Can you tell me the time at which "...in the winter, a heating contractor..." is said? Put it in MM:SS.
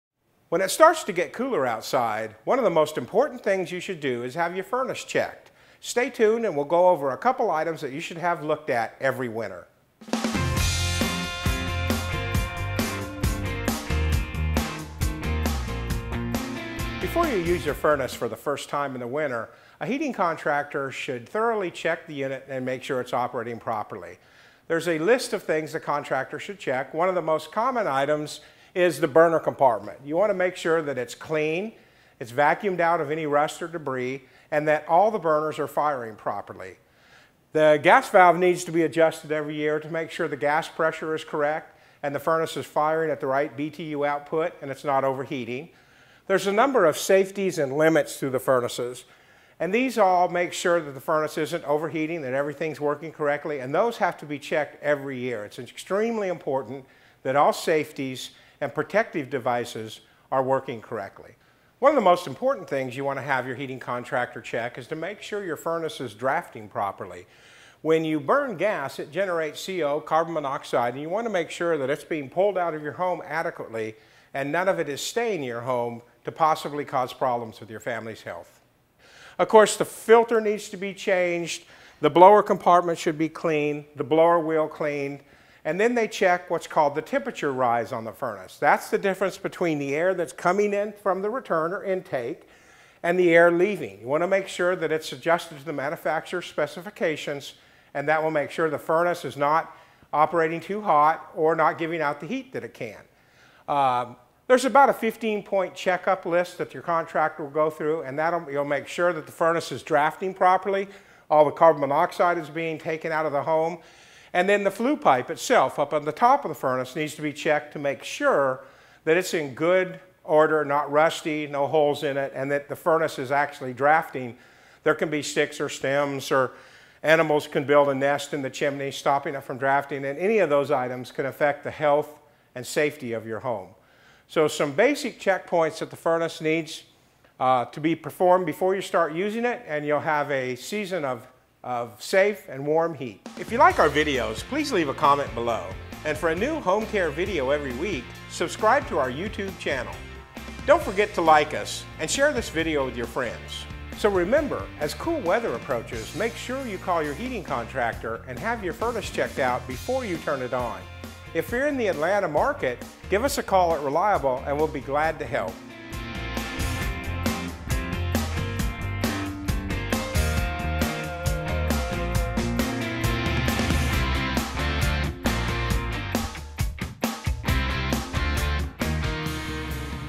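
00:18.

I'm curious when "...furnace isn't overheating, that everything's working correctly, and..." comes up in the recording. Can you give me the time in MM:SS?
00:51.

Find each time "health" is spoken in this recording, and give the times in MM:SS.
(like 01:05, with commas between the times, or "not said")
01:18, 02:11.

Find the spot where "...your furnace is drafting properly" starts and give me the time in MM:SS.
01:05.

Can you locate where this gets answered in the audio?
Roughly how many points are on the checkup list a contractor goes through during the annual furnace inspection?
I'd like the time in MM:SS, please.
01:44.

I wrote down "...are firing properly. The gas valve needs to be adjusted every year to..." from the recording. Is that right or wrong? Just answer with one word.
right.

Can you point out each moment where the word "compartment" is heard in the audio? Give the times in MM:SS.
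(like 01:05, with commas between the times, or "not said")
00:29, 01:22.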